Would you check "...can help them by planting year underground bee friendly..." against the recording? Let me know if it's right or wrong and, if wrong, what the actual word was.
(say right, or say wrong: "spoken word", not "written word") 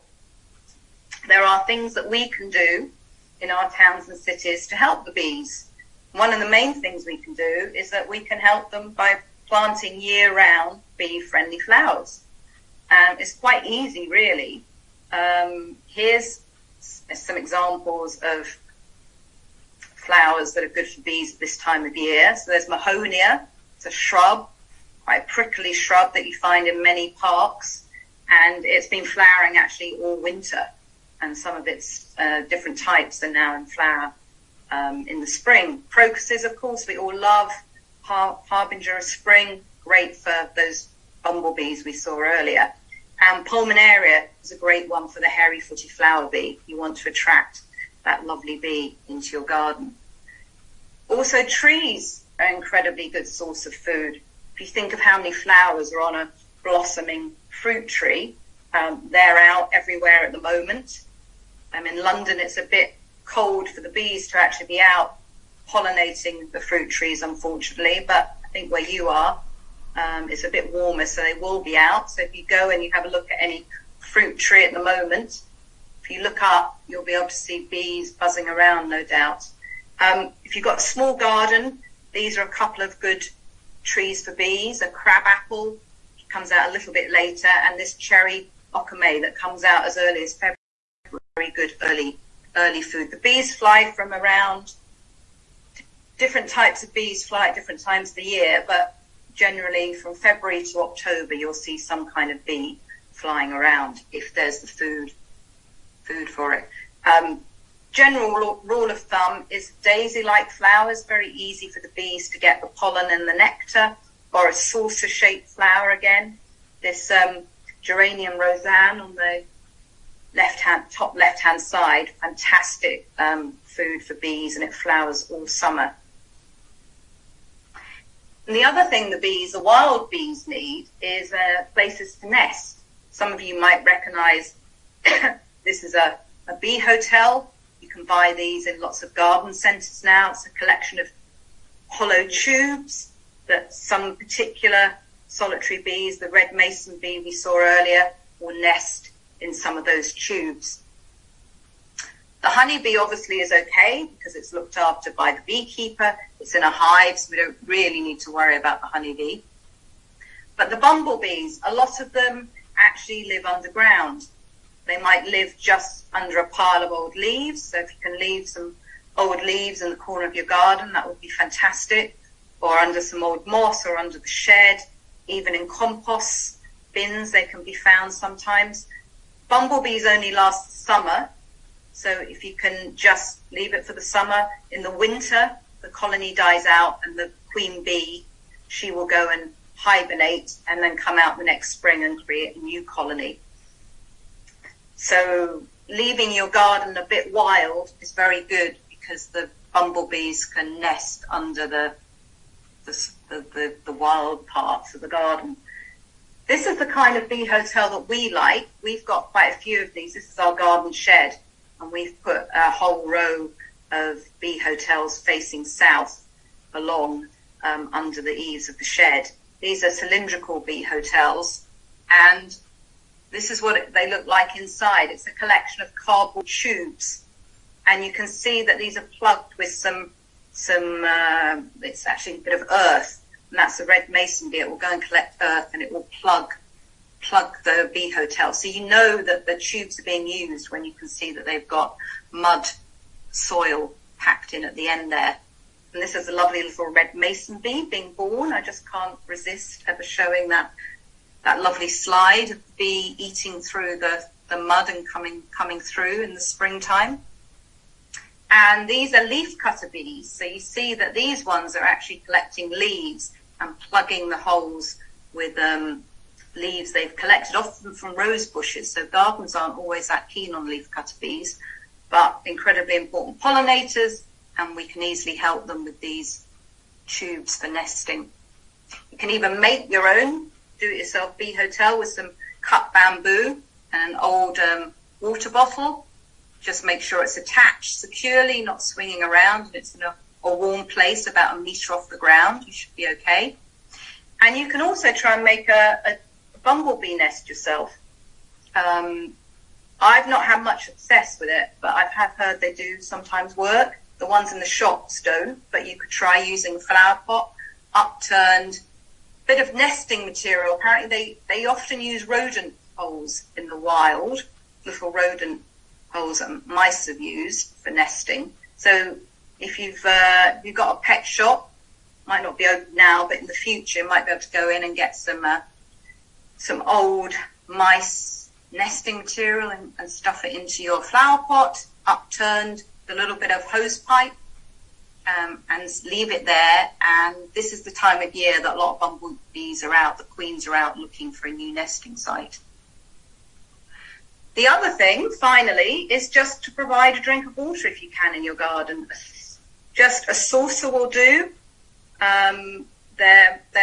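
wrong: "round", not "underground".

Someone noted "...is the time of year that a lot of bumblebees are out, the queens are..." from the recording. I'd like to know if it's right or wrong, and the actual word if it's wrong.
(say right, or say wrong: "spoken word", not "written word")
right.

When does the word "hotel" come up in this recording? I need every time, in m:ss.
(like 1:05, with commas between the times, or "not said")
2:16, 3:27, 3:34, 3:40, 3:58, 4:41.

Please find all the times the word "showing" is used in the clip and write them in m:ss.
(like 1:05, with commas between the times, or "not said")
4:10.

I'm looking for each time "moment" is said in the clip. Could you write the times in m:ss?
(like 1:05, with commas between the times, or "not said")
1:00, 1:14.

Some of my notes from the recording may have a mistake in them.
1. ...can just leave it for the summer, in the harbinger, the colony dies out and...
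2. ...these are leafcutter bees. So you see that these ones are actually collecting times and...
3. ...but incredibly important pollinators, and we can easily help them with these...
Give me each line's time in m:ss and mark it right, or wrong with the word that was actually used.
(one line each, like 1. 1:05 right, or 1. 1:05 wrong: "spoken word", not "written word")
1. 3:02 wrong: "winter", not "harbinger"
2. 4:18 wrong: "leaves", not "times"
3. 4:32 right.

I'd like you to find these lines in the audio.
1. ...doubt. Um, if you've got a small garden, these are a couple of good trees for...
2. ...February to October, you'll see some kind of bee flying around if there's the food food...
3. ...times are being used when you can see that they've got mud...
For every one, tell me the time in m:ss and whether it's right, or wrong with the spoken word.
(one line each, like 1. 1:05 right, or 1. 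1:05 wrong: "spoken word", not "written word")
1. 1:19 right
2. 1:40 right
3. 3:59 wrong: "tubes", not "times".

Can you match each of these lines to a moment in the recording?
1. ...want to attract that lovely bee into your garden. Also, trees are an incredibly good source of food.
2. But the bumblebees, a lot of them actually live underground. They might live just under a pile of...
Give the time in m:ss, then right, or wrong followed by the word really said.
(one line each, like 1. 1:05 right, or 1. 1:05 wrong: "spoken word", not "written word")
1. 0:46 right
2. 2:40 right.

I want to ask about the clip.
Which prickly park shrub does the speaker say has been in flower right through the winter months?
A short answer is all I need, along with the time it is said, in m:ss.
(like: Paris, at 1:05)
Mahonia, at 0:22.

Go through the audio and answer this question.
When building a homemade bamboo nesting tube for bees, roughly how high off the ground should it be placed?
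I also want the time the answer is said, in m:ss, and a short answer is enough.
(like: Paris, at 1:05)
about 1 meter, at 4:51.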